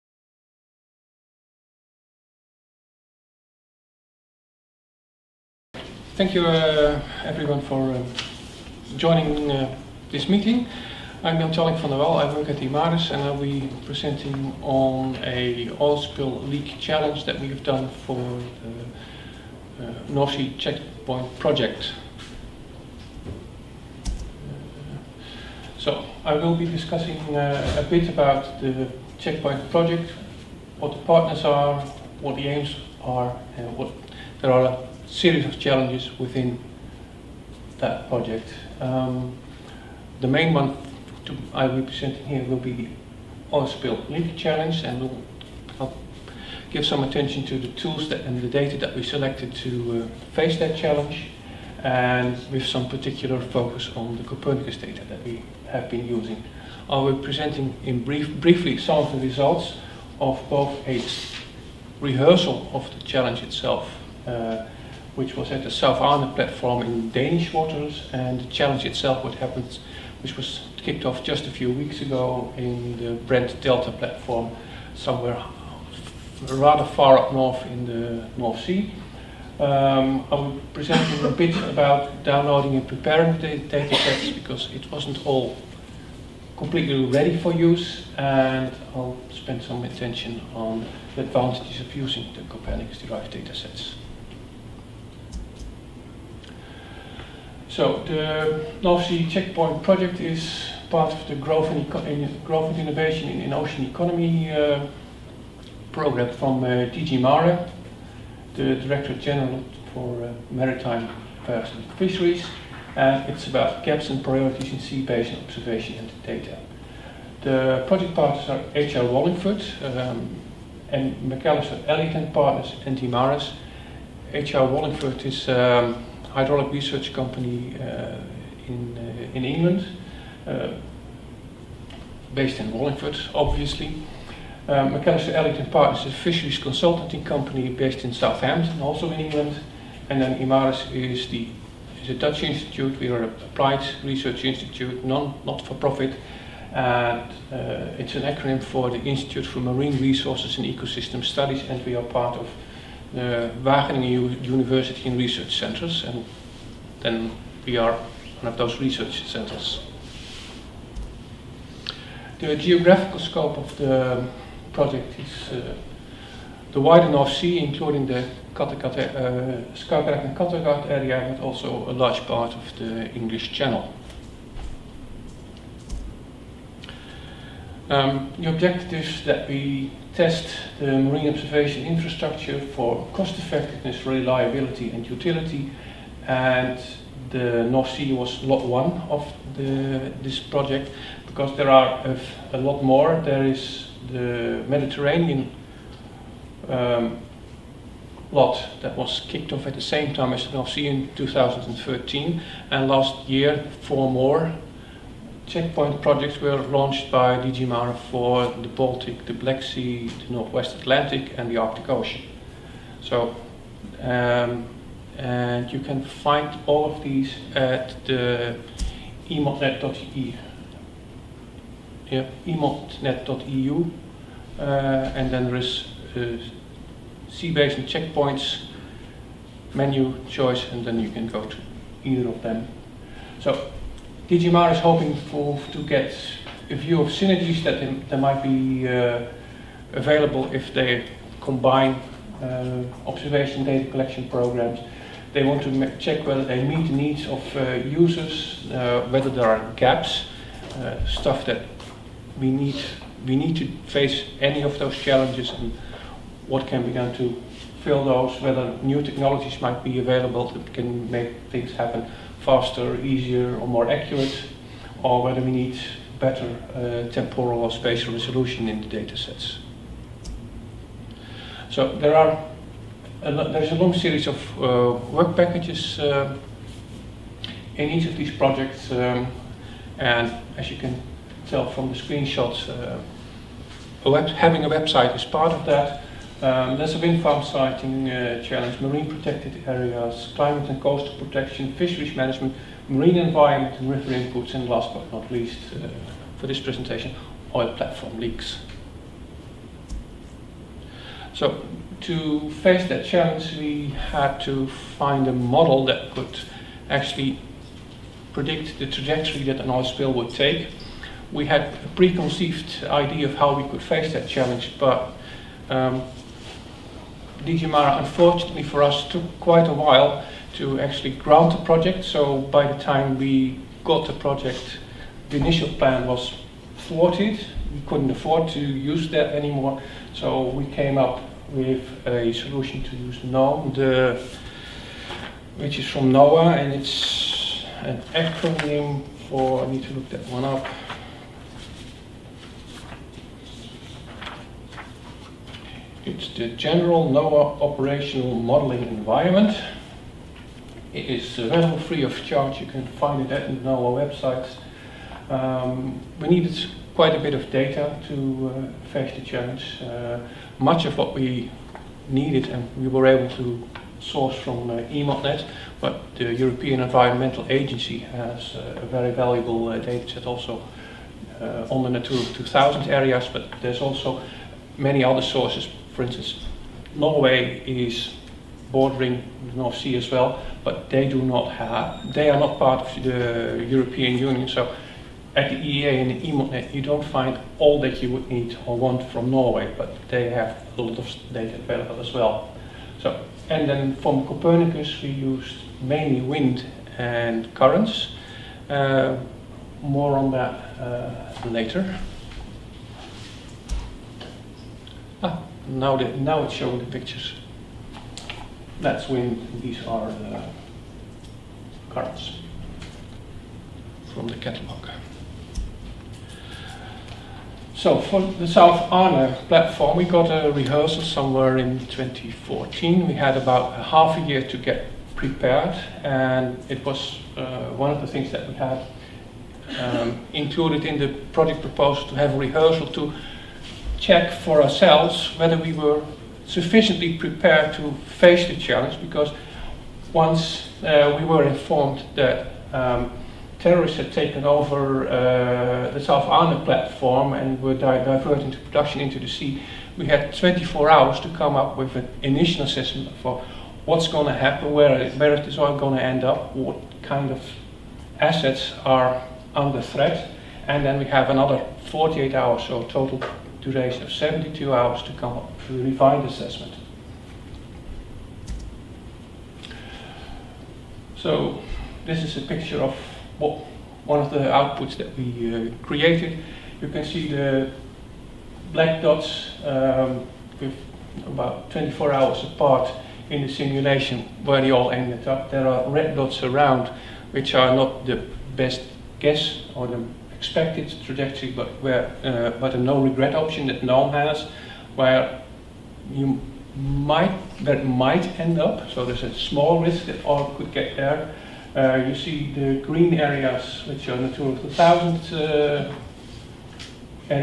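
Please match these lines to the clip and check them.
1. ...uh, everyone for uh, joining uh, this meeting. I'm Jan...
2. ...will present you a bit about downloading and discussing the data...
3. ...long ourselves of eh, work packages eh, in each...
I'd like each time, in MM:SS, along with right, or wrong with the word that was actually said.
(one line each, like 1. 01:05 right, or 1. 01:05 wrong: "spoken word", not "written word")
1. 00:06 right
2. 01:20 wrong: "preparing", not "discussing"
3. 04:33 wrong: "series", not "ourselves".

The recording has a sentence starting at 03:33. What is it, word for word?
So um, and you can find all of these at the emodnet.eu.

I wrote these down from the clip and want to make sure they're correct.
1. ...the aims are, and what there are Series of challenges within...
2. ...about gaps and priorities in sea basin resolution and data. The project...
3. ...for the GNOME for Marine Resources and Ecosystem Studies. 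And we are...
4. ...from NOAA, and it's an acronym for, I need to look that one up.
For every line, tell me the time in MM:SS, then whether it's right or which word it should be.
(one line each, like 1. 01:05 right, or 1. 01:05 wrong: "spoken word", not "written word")
1. 00:32 right
2. 01:53 wrong: "observation", not "resolution"
3. 02:28 wrong: "Institute", not "GNOME"
4. 05:35 right.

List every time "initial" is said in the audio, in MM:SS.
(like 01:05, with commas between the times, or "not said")
05:25, 07:32.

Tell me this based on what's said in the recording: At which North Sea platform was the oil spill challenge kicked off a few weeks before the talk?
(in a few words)
Brent Delta.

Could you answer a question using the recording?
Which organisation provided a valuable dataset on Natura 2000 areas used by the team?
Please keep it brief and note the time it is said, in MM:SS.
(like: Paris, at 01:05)
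European Environmental Agency, at 06:06.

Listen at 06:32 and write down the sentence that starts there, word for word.
So, and then from Copernicus, we used mainly wind and currents.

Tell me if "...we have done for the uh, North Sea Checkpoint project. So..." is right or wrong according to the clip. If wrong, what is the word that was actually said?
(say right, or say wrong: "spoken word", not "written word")
right.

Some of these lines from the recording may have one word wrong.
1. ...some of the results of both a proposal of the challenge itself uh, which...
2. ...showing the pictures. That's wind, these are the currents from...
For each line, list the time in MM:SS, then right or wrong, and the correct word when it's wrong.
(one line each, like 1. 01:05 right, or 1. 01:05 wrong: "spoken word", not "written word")
1. 00:58 wrong: "rehearsal", not "proposal"
2. 06:46 right.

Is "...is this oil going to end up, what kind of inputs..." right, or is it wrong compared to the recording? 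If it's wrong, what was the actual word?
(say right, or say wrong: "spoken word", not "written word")
wrong: "assets", not "inputs".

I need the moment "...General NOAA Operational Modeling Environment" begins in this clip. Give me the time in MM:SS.
05:46.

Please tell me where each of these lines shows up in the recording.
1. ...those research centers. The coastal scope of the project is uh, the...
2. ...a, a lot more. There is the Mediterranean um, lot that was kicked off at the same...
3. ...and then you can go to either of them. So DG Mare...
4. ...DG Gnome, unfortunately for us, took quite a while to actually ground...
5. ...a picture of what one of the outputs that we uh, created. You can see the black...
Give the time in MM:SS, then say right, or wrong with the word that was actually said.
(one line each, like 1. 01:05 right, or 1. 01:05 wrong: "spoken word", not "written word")
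1. 02:38 wrong: "geographical", not "coastal"
2. 03:12 right
3. 03:50 right
4. 05:17 wrong: "Mare", not "Gnome"
5. 07:52 right.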